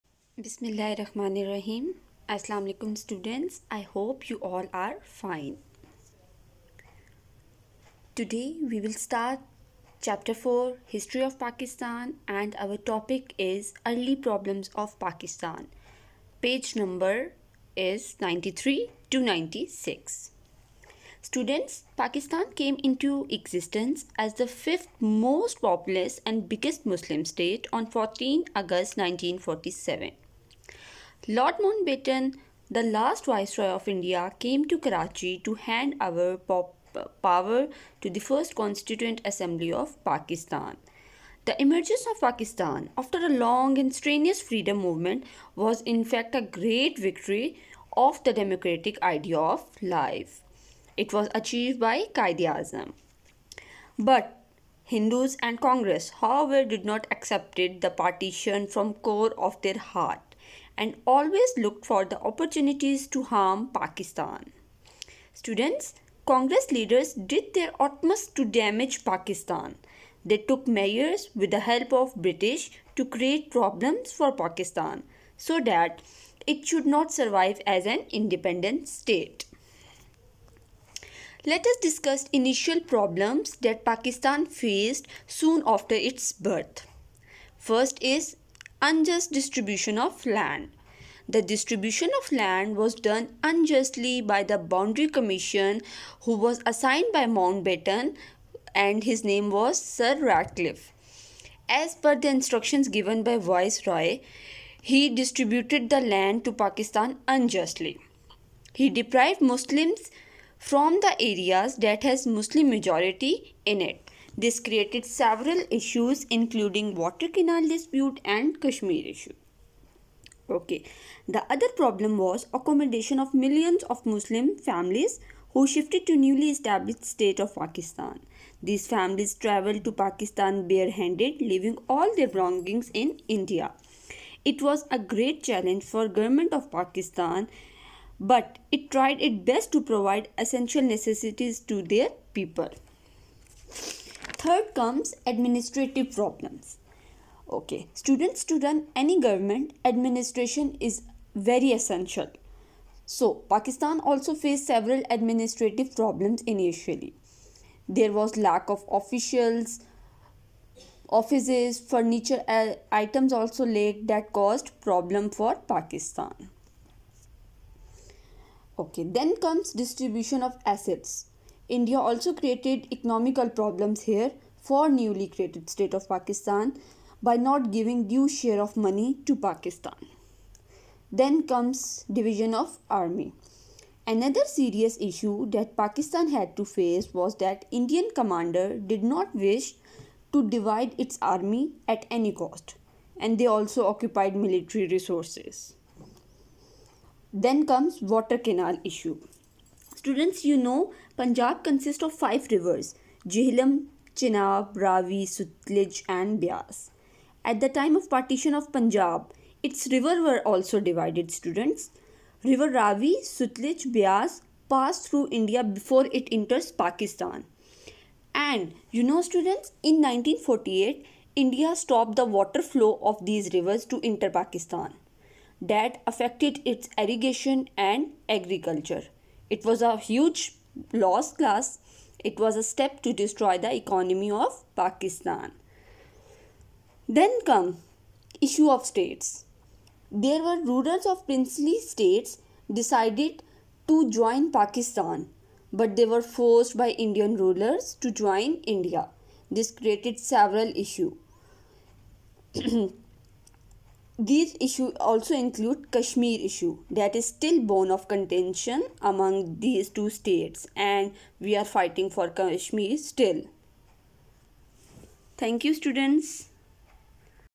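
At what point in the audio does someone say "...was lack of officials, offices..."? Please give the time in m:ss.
2:38.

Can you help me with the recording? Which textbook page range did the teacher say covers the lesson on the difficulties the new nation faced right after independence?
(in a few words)
93 to 96.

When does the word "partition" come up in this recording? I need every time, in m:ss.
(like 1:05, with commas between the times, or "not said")
0:57, 3:28.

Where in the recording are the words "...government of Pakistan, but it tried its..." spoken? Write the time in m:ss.
2:16.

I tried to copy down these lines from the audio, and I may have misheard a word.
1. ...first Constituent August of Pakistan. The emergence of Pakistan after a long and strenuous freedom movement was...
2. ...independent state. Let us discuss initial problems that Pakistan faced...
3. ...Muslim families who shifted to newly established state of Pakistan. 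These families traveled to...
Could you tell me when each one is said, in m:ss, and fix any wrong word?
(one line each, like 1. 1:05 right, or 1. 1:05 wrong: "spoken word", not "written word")
1. 0:38 wrong: "Assembly", not "August"
2. 1:18 right
3. 2:04 right.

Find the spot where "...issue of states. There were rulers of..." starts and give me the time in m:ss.
3:58.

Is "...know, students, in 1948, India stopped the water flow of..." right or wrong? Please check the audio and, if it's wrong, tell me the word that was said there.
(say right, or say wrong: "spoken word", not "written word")
right.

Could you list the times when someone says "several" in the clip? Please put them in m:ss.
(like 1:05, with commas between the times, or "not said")
1:55, 2:34, 4:10.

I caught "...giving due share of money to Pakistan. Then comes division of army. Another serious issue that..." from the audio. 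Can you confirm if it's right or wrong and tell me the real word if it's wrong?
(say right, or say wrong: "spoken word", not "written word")
right.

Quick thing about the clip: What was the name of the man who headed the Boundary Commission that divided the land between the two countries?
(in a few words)
Sir Radcliffe.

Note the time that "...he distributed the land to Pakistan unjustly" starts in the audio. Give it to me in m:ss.
1:44.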